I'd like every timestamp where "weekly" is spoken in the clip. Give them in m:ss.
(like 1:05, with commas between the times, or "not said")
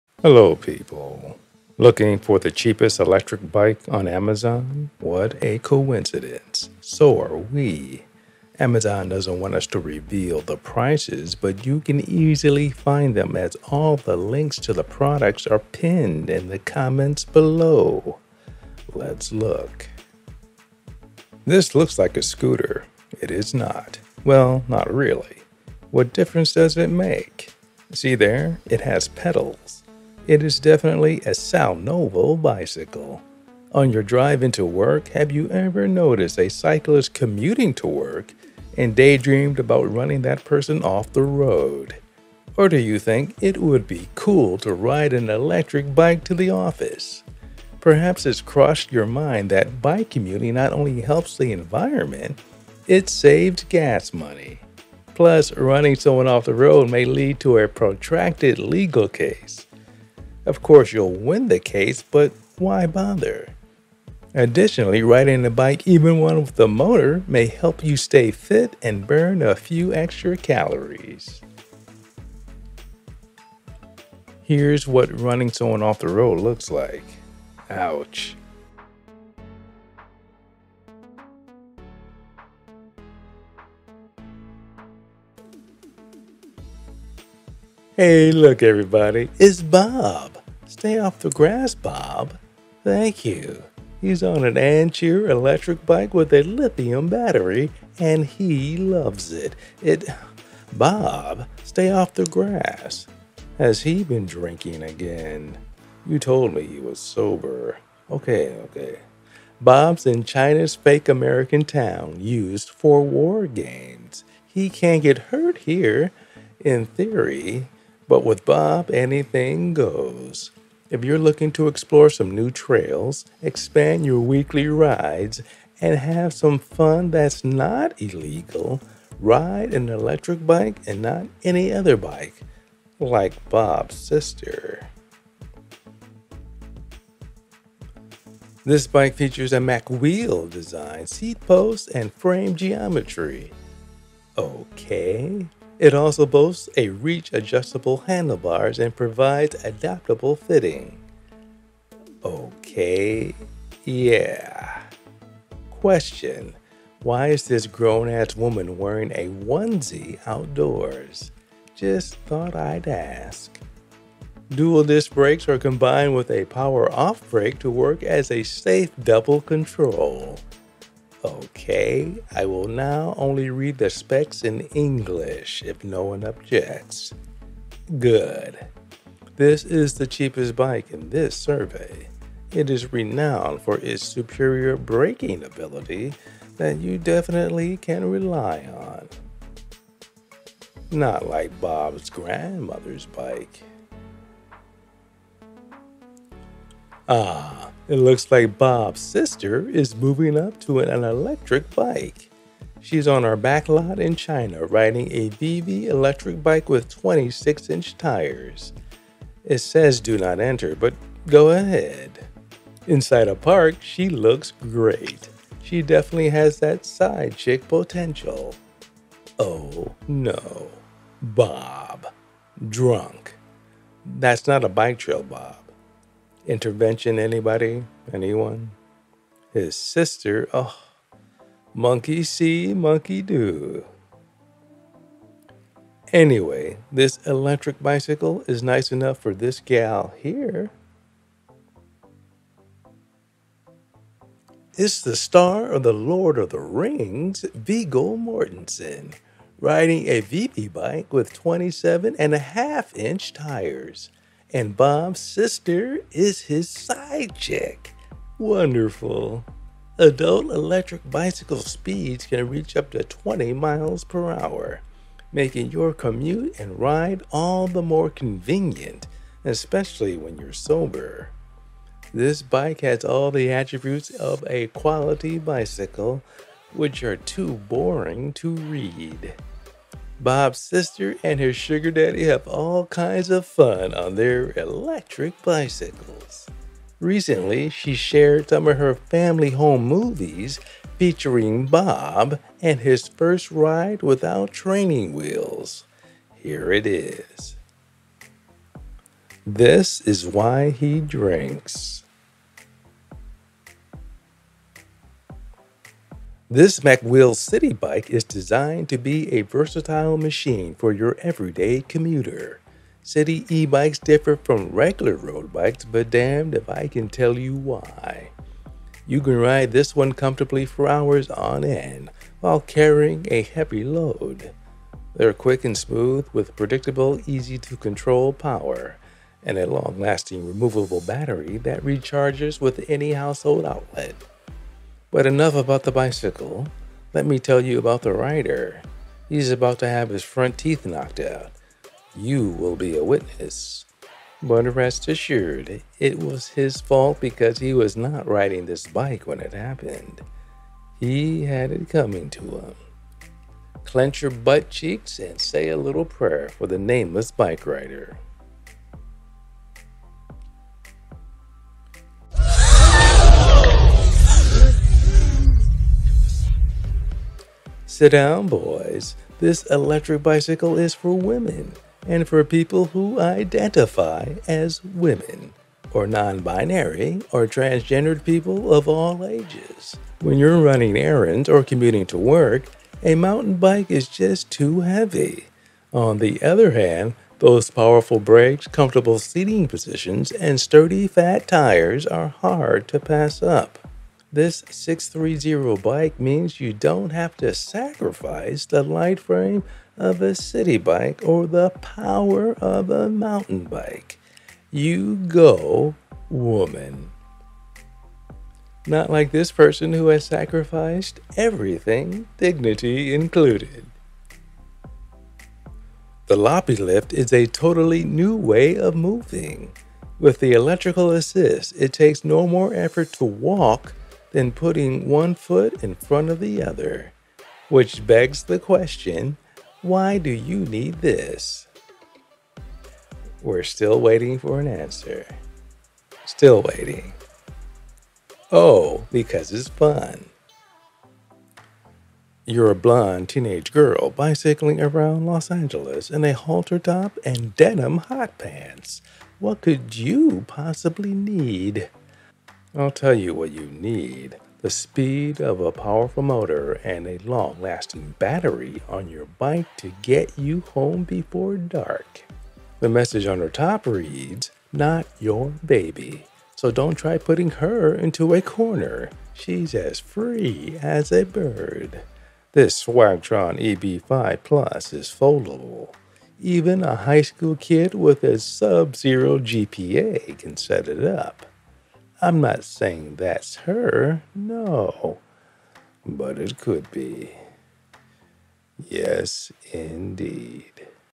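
2:04.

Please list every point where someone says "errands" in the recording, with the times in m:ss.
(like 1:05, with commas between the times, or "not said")
6:20.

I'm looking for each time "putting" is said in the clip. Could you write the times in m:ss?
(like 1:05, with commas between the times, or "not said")
7:04, 7:47.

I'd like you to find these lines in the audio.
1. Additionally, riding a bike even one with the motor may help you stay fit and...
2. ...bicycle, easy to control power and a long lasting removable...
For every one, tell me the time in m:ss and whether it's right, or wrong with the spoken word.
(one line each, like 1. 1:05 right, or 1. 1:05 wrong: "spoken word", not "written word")
1. 1:04 right
2. 5:26 wrong: "predictable", not "bicycle".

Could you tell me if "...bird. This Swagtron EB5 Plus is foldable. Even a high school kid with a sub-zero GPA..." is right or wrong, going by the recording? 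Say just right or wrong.
right.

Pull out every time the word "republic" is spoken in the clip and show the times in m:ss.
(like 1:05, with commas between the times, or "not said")
not said.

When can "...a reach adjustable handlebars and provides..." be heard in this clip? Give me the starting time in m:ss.
2:26.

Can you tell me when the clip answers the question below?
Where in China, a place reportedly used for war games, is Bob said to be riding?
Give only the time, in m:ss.
1:50.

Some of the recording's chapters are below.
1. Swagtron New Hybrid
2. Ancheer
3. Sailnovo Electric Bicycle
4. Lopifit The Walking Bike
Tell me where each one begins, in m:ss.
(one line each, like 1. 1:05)
1. 7:21
2. 1:25
3. 0:20
4. 6:46.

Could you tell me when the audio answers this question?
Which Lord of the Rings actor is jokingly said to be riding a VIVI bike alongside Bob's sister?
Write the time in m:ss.
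4:07.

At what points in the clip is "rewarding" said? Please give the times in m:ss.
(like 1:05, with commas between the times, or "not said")
not said.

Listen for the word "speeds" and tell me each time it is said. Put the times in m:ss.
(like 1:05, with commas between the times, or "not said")
4:21, 7:34.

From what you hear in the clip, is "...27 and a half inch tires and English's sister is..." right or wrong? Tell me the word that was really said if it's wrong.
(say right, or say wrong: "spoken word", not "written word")
wrong: "Bob", not "English".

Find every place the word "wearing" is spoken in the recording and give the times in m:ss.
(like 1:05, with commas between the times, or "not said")
2:38.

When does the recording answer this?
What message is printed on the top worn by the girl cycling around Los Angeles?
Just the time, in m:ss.
7:44.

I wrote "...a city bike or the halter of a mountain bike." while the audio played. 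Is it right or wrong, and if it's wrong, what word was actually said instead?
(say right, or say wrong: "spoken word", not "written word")
wrong: "power", not "halter".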